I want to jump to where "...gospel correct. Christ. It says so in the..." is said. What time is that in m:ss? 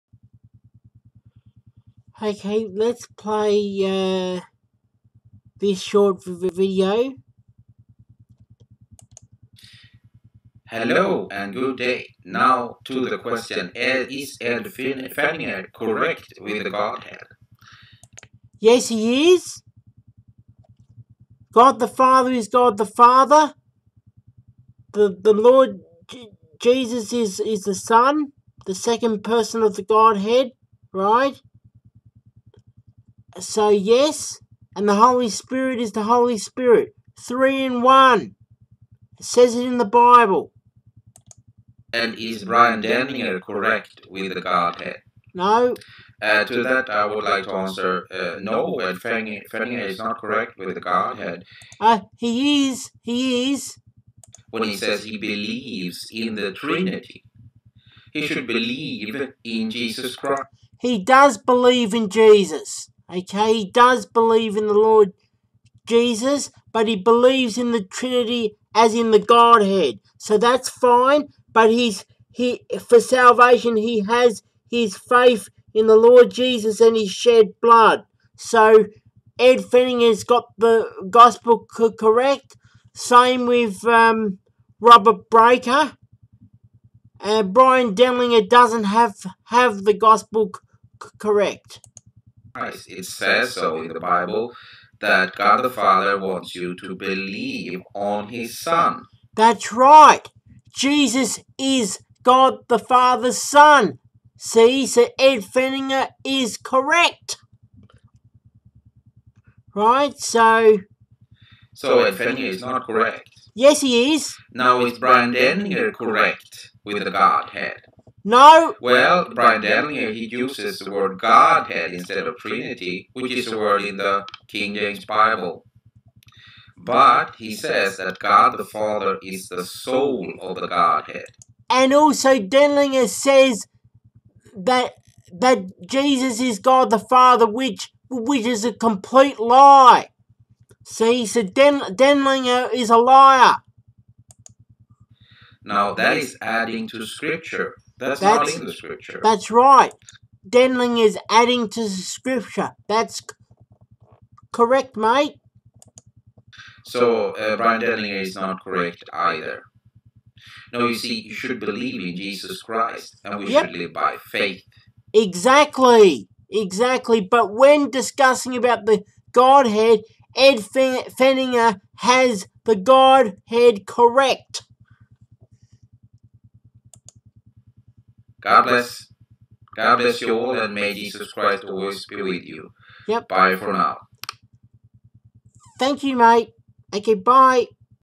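1:29.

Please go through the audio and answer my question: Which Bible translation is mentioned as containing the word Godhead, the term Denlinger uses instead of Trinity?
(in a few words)
King James Bible.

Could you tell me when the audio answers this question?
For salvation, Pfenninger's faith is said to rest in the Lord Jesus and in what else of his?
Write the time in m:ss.
1:16.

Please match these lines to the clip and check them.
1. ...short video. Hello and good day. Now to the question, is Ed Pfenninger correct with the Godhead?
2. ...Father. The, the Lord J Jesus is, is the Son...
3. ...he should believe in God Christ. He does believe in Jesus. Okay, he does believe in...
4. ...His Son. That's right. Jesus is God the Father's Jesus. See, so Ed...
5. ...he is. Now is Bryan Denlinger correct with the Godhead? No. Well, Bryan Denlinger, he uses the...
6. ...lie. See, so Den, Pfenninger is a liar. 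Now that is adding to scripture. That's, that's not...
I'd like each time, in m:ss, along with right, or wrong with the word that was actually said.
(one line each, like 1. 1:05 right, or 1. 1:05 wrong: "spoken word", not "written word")
1. 0:05 right
2. 0:22 right
3. 0:58 wrong: "Jesus", not "God"
4. 1:38 wrong: "Son", not "Jesus"
5. 1:53 right
6. 2:19 wrong: "Denlinger", not "Pfenninger".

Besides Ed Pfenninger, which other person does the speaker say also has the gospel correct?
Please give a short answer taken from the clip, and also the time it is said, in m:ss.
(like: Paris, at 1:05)
Robert Breaker, at 1:24.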